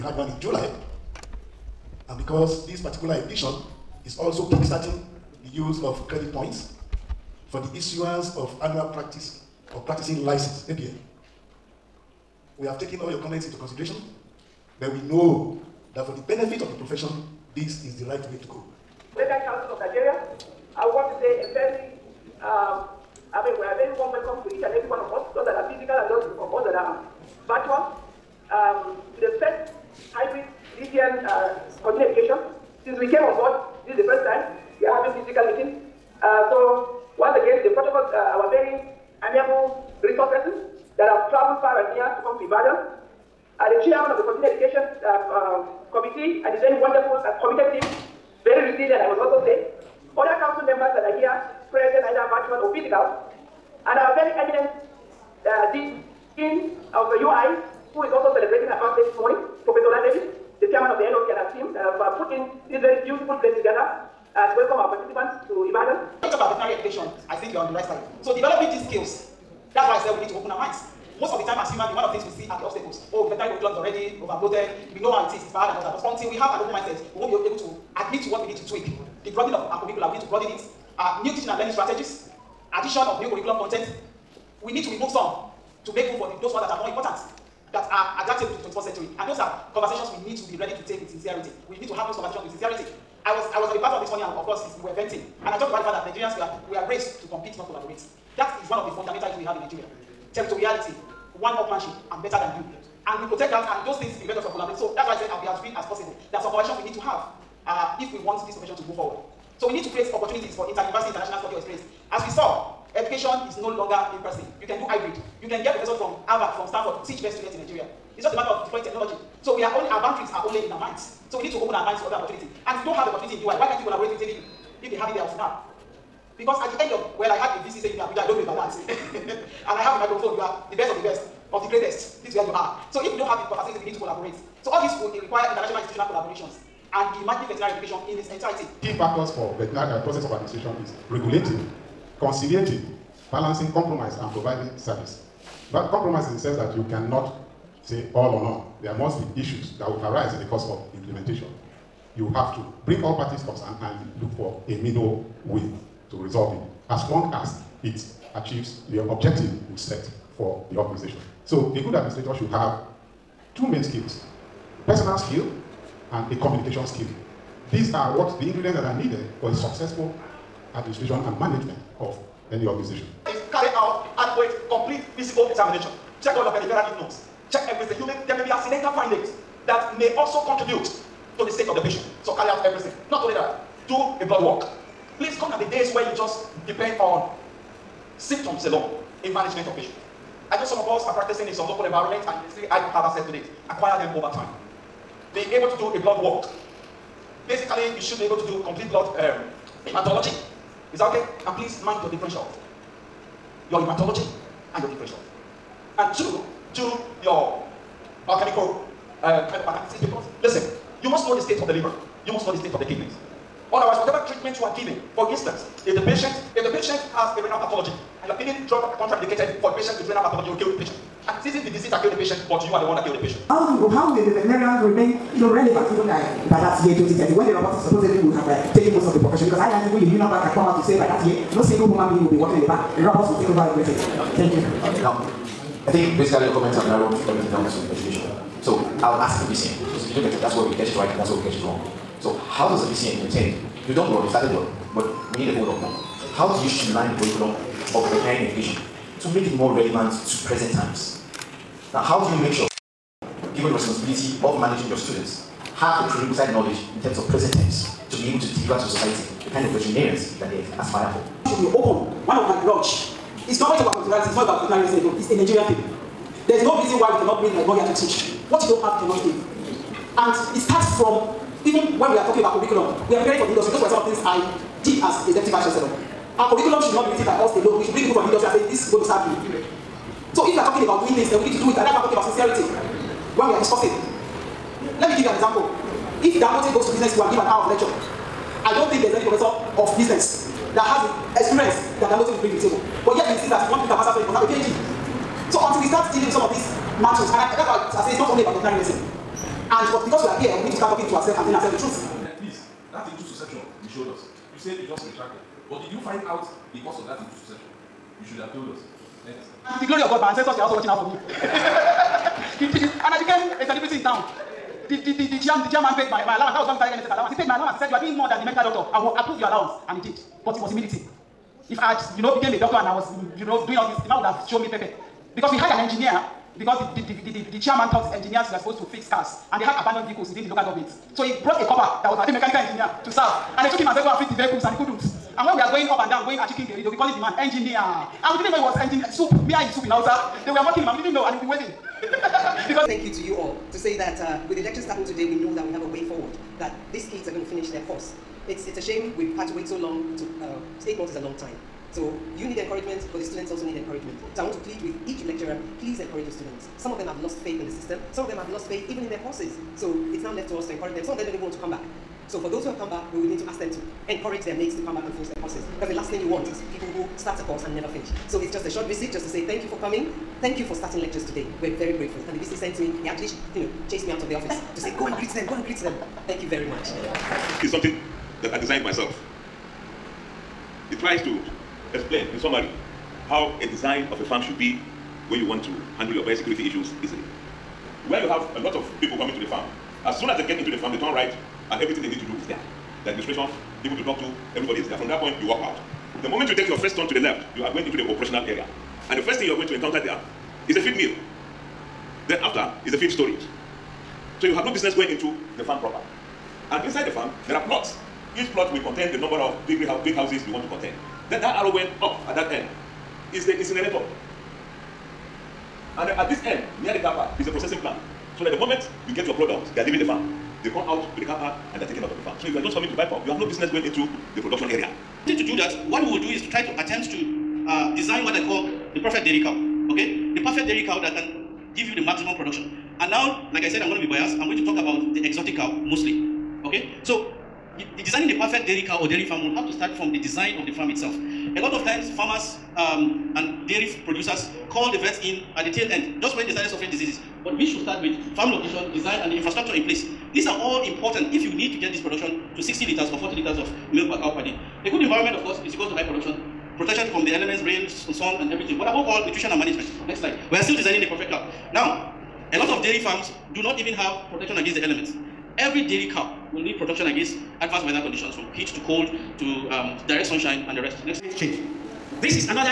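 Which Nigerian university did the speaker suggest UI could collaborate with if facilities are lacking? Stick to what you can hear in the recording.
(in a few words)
ABU.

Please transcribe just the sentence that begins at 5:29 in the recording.
And they had abandoned vehicles within the local government.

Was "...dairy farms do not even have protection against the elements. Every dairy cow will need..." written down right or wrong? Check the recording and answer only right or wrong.
right.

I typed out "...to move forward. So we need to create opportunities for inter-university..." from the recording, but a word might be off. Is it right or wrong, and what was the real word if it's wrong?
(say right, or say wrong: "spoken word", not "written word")
right.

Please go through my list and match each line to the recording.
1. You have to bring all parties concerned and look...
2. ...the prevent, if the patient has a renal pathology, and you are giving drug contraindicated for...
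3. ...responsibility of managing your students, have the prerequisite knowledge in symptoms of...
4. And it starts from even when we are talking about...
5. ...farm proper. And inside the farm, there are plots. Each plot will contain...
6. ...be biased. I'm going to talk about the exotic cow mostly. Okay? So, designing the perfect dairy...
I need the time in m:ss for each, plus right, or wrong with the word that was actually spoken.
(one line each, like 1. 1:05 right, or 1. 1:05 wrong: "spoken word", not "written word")
1. 2:32 right
2. 3:35 wrong: "patient", not "prevent"
3. 4:13 wrong: "terms", not "symptoms"
4. 4:30 right
5. 6:45 right
6. 7:14 right.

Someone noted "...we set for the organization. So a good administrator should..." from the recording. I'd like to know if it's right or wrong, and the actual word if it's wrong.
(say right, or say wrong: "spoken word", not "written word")
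right.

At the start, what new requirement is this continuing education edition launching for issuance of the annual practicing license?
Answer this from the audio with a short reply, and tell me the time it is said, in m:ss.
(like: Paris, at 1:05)
credit points, at 0:06.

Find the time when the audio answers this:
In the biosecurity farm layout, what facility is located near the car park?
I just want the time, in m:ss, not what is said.
6:57.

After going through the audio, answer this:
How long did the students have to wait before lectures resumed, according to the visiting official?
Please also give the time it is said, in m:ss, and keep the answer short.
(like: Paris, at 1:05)
8 months, at 5:50.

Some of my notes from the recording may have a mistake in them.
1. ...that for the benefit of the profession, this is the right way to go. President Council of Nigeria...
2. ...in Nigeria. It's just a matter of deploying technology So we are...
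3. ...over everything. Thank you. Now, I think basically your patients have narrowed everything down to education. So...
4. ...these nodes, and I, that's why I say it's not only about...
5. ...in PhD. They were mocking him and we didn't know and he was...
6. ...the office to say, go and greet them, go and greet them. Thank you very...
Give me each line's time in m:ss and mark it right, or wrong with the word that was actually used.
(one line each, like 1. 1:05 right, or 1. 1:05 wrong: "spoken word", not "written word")
1. 0:15 right
2. 1:57 right
3. 3:53 wrong: "comments", not "patients"
4. 4:56 wrong: "mantles", not "nodes"
5. 5:39 wrong: "Hausa", not "PhD"
6. 6:14 right.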